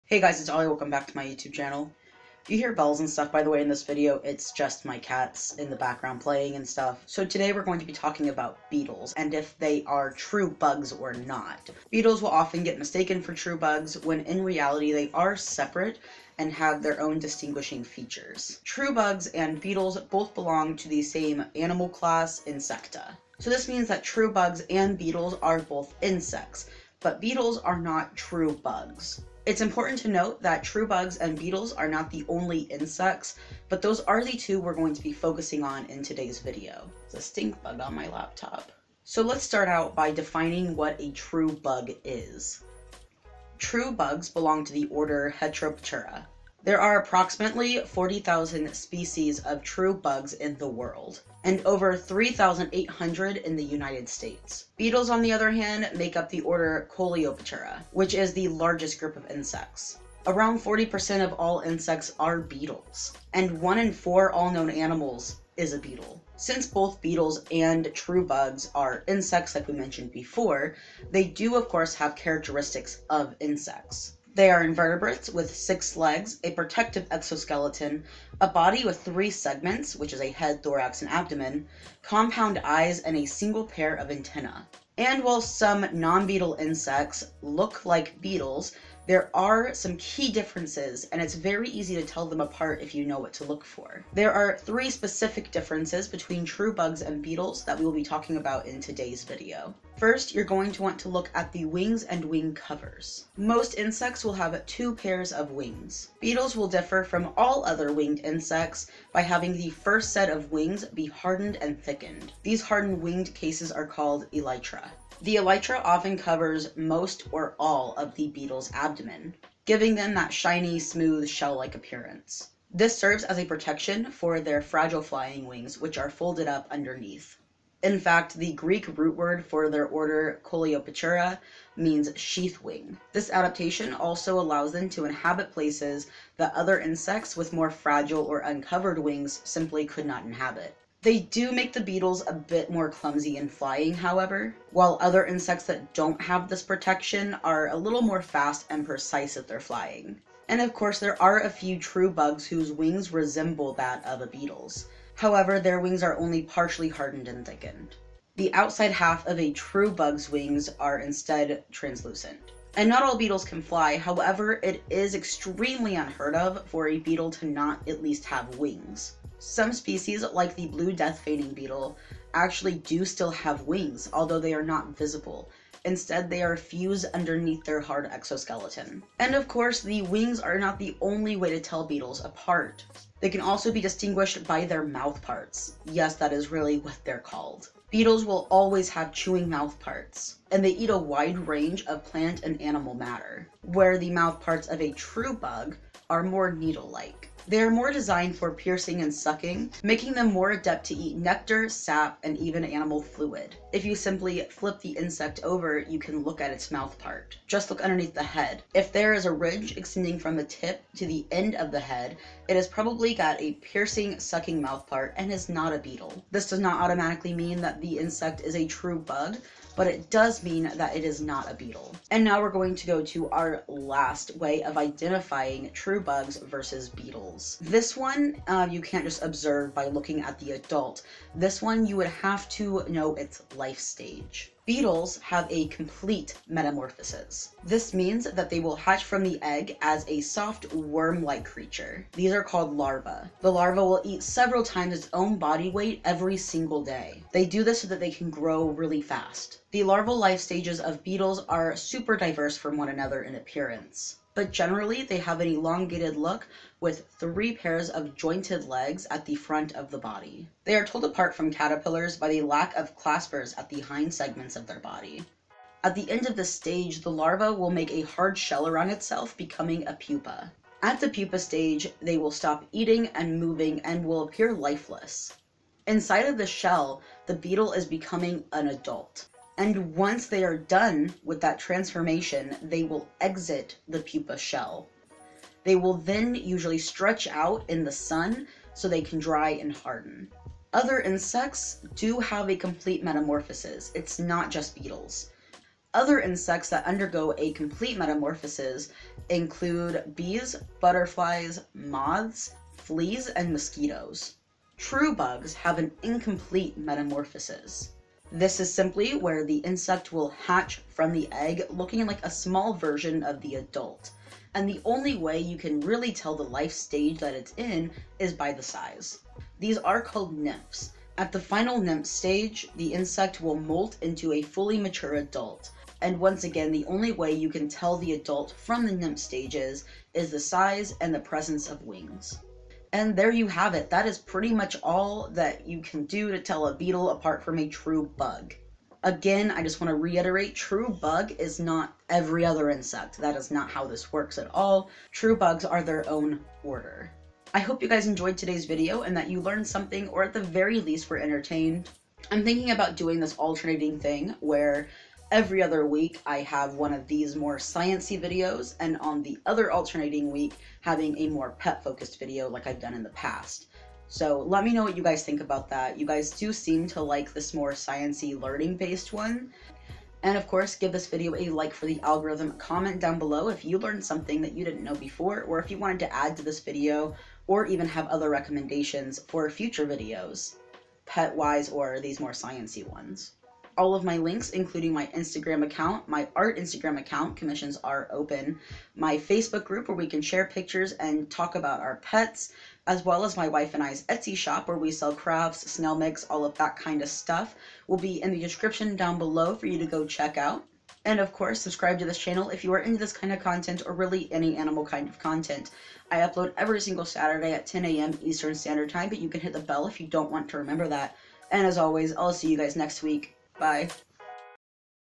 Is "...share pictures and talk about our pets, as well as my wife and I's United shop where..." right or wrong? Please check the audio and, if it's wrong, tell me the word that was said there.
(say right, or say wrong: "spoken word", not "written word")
wrong: "Etsy", not "United".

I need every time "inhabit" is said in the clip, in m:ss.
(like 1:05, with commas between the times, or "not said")
2:15, 2:20.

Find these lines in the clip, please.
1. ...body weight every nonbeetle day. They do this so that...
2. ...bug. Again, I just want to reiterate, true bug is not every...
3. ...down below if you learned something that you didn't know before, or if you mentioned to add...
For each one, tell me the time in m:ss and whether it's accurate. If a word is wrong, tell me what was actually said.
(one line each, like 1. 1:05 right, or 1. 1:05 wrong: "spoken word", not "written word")
1. 4:05 wrong: "single", not "nonbeetle"
2. 5:38 right
3. 6:12 wrong: "wanted", not "mentioned".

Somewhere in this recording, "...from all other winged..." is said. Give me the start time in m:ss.
1:47.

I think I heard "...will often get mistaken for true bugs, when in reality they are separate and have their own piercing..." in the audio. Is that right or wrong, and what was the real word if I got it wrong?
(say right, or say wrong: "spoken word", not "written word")
wrong: "distinguishing", not "piercing".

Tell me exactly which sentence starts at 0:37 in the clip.
It's a stink bug on my laptop.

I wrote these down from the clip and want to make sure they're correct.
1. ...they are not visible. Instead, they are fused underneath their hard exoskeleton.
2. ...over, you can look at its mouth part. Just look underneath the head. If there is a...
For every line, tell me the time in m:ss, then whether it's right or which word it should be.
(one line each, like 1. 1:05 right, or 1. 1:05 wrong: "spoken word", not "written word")
1. 2:54 right
2. 3:25 right.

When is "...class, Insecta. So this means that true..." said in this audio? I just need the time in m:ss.
0:21.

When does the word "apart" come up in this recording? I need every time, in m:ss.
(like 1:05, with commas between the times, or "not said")
1:32, 3:02, 4:21, 5:37.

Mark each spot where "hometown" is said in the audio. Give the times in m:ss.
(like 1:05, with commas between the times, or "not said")
not said.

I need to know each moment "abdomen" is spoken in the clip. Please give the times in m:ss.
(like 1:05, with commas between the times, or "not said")
1:21, 1:58.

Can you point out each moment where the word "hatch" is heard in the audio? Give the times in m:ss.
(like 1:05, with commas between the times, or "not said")
3:58, 5:10.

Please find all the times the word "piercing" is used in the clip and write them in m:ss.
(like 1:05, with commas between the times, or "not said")
3:18, 3:33.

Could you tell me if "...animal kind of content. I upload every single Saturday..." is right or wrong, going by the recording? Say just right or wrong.
right.